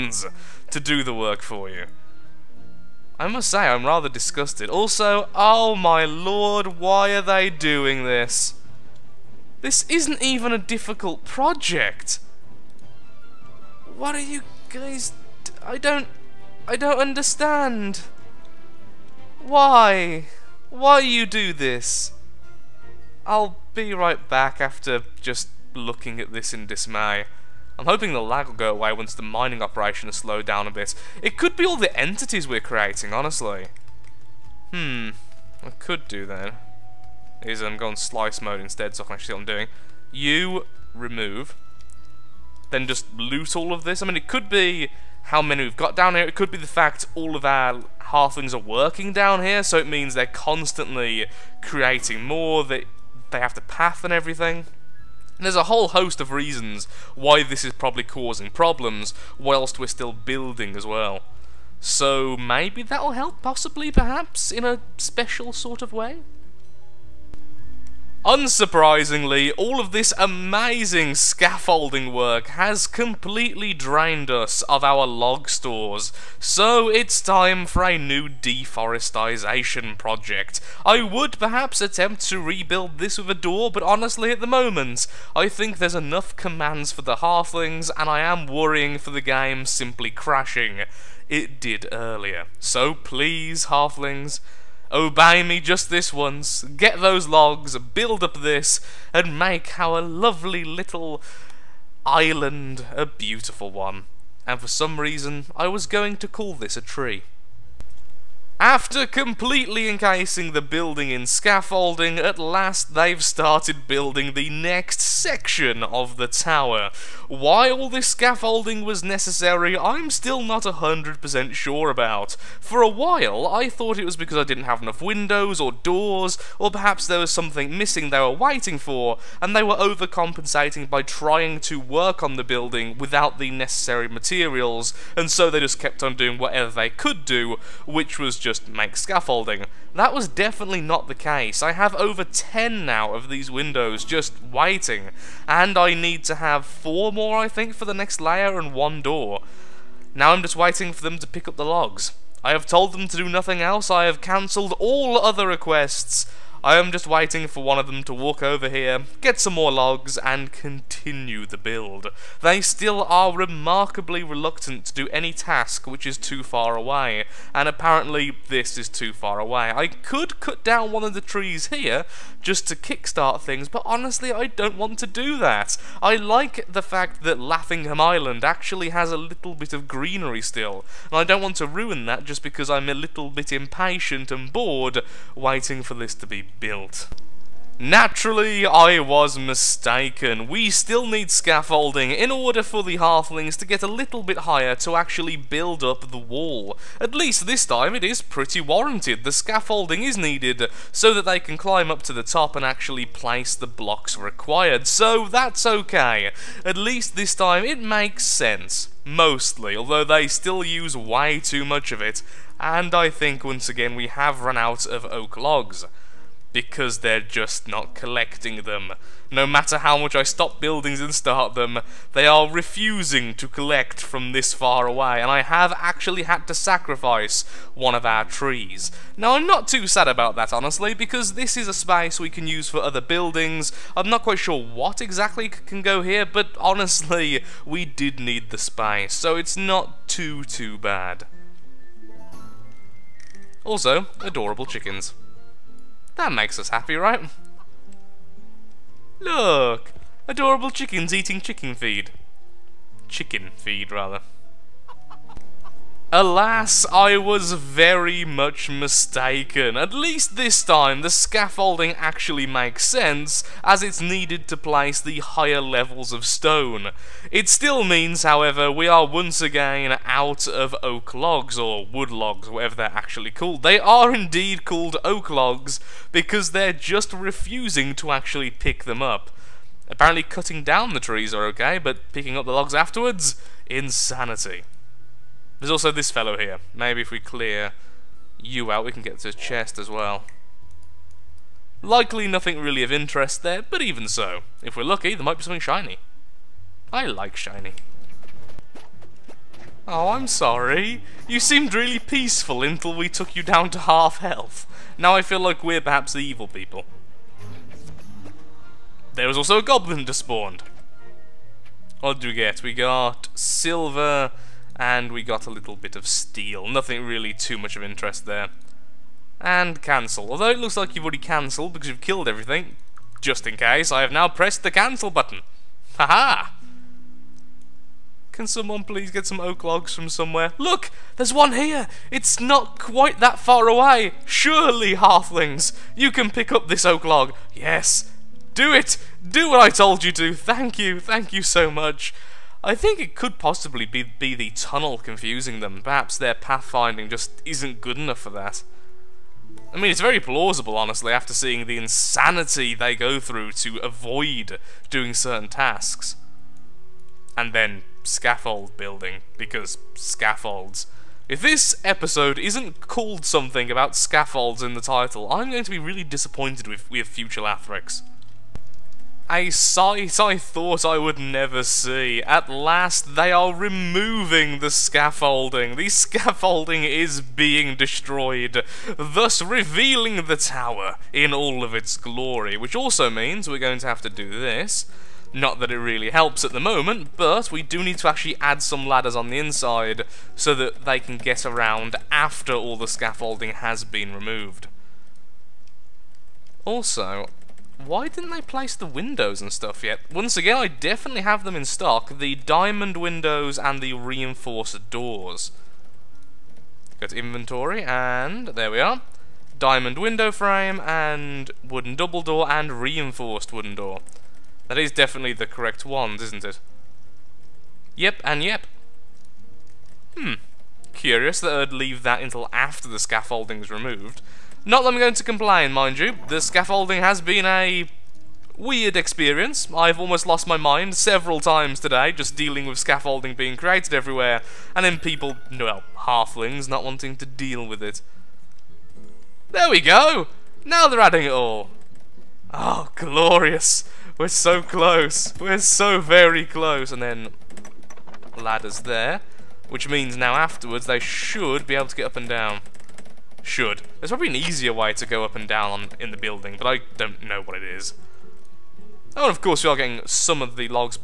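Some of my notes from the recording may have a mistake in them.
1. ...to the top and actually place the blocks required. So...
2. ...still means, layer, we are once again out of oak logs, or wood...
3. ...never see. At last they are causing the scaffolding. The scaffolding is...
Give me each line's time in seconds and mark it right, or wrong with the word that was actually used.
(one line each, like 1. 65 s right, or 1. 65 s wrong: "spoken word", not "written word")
1. 202 s right
2. 267 s wrong: "however", not "layer"
3. 371 s wrong: "removing", not "causing".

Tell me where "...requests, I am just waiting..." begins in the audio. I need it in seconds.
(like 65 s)
155 s.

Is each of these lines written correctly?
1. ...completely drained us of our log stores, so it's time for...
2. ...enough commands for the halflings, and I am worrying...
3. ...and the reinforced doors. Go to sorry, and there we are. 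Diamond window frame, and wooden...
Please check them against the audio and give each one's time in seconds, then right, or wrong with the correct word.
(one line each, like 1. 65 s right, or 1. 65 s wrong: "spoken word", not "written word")
1. 72 s right
2. 85 s right
3. 403 s wrong: "inventory", not "sorry".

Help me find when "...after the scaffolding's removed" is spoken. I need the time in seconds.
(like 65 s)
422 s.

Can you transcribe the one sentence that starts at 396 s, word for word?
Also, why didn't they place the windows and stuff yet?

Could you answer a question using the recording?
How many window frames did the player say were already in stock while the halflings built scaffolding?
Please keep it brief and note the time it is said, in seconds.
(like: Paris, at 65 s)
Over 10, at 141 s.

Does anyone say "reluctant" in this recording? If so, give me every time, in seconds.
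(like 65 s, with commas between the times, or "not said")
164 s.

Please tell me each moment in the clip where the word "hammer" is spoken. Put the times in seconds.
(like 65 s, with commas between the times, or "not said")
not said.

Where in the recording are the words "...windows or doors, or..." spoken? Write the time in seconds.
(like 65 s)
125 s.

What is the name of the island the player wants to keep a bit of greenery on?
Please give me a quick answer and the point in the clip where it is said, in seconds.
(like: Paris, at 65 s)
Laughingham Island, at 177 s.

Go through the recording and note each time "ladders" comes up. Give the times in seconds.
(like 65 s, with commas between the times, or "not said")
388 s, 448 s.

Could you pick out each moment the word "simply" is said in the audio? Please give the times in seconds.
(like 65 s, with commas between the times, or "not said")
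89 s.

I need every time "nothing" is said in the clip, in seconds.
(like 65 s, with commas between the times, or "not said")
153 s, 292 s, 316 s.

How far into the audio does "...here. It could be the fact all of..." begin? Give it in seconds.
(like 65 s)
46 s.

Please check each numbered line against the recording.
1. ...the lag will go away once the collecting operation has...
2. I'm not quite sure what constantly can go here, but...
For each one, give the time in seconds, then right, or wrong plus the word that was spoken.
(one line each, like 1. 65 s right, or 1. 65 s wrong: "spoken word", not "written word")
1. 28 s wrong: "mining", not "collecting"
2. 233 s wrong: "exactly", not "constantly".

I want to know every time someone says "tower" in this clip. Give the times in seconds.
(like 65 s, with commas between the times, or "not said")
116 s, 380 s.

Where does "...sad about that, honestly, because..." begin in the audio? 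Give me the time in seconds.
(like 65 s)
229 s.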